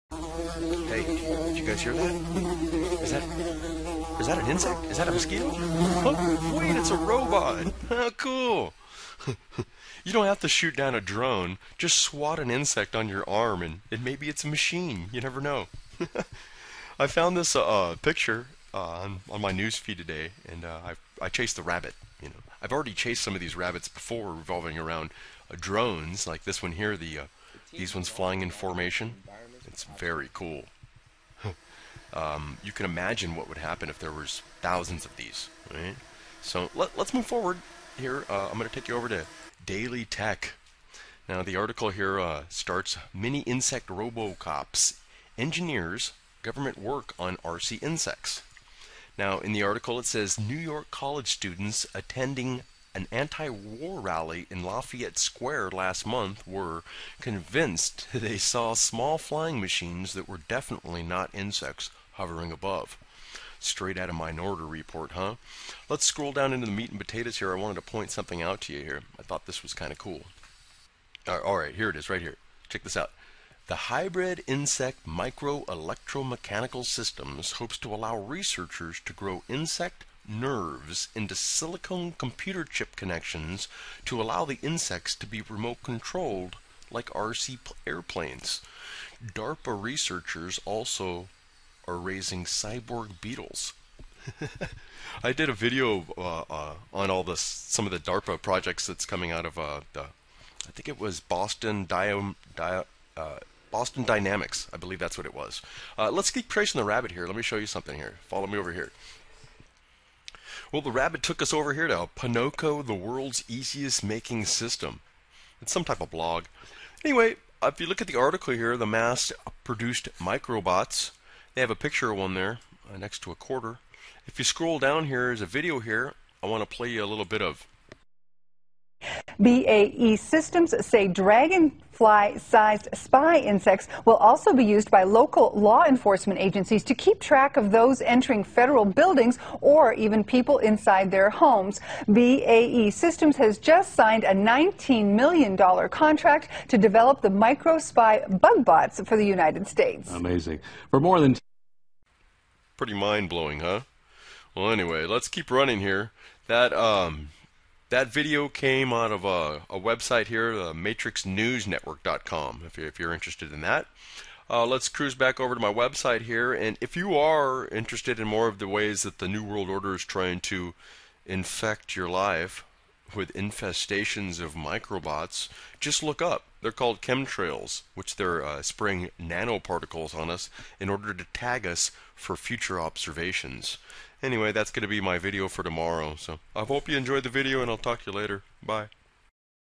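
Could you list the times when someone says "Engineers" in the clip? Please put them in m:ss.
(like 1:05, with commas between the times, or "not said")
0:45.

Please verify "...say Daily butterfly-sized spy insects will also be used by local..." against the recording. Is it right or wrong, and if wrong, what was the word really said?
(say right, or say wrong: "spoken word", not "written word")
wrong: "Dragon", not "Daily".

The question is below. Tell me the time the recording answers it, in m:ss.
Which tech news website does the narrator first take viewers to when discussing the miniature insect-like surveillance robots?
0:39.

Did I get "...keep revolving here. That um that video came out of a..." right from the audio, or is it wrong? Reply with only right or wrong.
wrong.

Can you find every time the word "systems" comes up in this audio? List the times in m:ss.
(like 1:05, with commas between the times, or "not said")
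1:16, 1:54, 2:10, 2:22.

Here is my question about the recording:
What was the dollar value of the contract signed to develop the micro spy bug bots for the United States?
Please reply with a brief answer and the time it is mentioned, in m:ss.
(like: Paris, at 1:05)
$19 million, at 2:24.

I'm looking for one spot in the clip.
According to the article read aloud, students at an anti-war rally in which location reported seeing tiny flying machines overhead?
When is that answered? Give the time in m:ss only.
0:54.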